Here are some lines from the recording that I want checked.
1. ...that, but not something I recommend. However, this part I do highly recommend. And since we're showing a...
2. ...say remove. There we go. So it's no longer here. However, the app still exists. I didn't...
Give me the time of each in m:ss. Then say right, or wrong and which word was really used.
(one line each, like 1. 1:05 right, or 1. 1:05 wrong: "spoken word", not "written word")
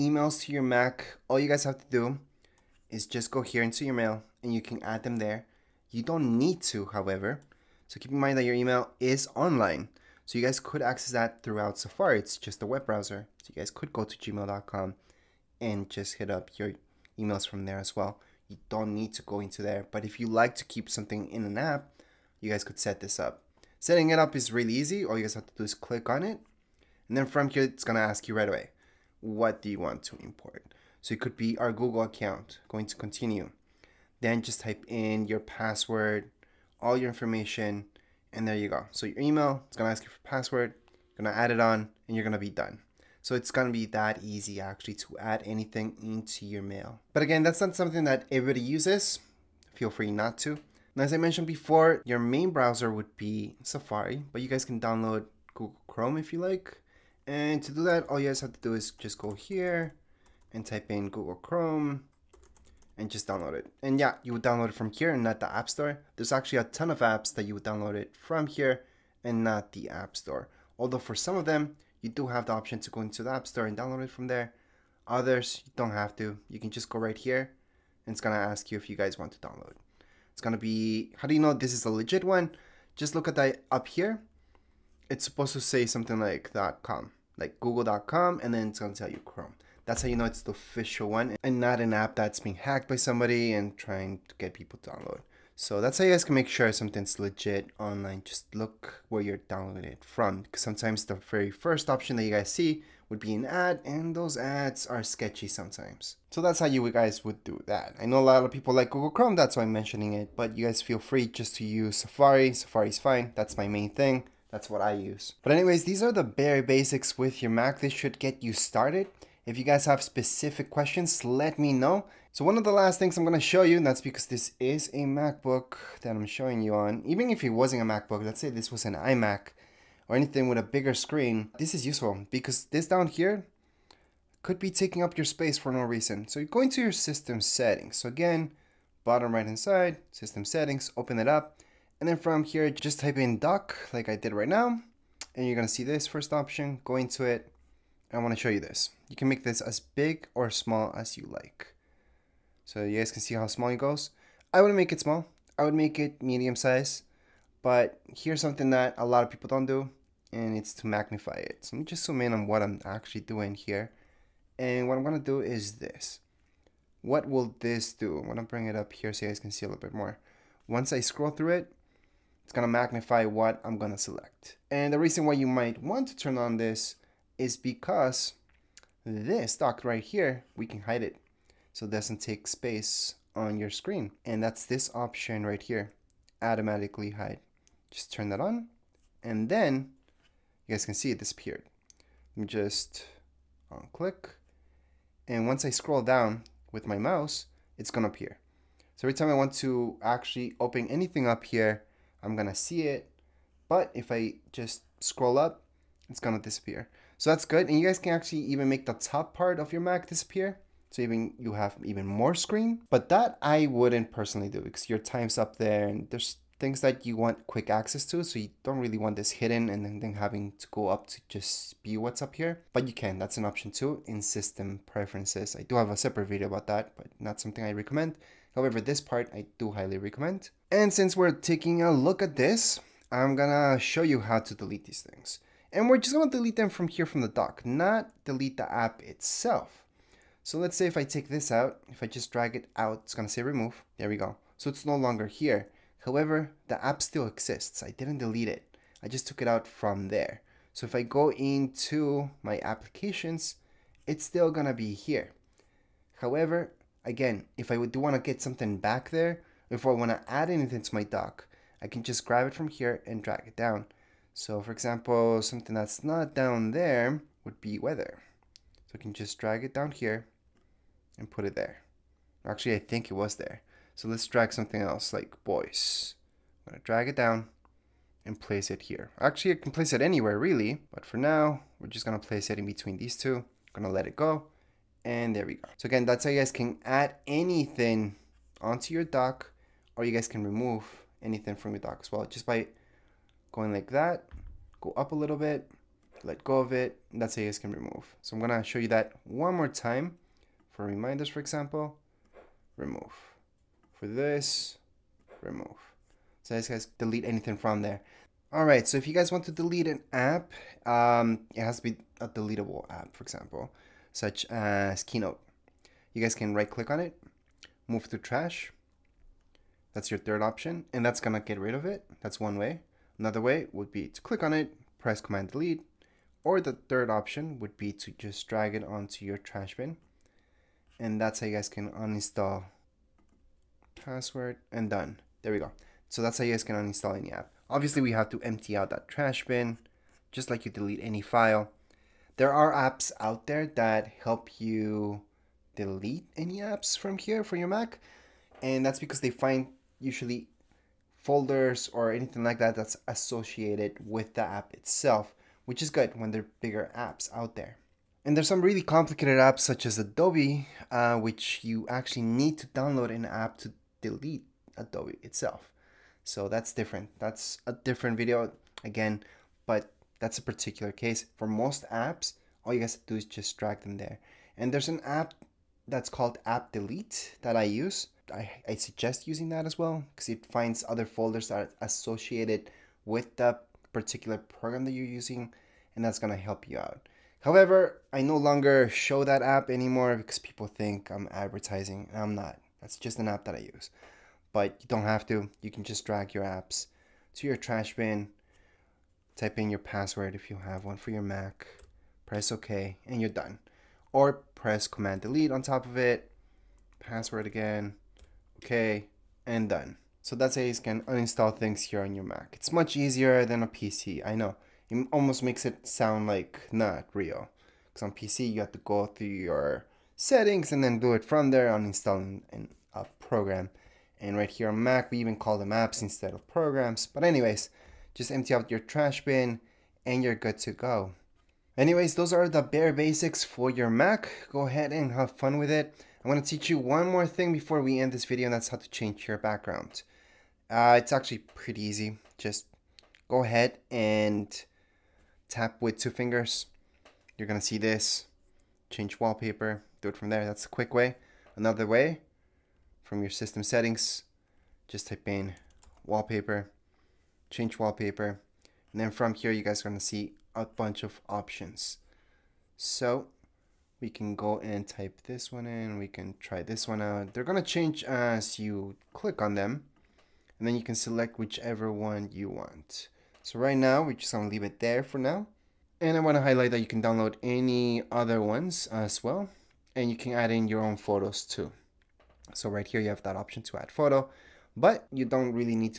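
1. 3:46 wrong: "taking", not "showing"
2. 4:03 right.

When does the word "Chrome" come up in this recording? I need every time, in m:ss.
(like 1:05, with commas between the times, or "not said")
0:55, 1:01, 1:29, 1:49.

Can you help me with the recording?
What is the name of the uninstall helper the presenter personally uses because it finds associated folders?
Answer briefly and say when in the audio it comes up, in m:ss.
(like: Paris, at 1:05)
App Delete, at 6:16.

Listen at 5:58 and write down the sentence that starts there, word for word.
And there's some really complicated apps such as Adobe uh, which you actually need to download an app to delete Adobe itself.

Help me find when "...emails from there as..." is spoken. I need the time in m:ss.
0:17.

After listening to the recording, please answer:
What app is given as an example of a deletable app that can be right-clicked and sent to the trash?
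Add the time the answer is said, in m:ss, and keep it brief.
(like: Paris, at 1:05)
Keynote, at 5:15.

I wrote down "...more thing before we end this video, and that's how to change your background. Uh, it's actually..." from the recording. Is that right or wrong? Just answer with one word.
right.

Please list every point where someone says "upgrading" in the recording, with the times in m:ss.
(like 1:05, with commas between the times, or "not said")
not said.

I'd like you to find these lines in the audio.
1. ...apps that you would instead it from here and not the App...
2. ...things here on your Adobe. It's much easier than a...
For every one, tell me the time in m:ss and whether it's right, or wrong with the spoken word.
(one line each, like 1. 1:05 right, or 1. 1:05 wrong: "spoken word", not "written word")
1. 1:07 wrong: "download", not "instead"
2. 6:51 wrong: "Mac", not "Adobe".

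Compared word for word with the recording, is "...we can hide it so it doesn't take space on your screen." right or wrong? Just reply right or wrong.
right.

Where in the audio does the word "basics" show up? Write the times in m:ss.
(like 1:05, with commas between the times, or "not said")
1:56, 7:12.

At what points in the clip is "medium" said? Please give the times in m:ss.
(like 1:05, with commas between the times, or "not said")
2:36.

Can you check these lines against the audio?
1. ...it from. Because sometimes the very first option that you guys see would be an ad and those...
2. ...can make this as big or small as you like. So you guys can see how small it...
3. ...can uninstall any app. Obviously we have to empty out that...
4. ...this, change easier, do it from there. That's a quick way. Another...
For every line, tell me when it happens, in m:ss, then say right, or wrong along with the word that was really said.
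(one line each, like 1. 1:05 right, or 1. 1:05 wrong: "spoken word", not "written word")
1. 1:39 right
2. 2:29 right
3. 5:36 right
4. 7:27 wrong: "wallpaper", not "easier".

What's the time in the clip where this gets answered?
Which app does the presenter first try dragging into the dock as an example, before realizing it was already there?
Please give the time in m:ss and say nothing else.
4:27.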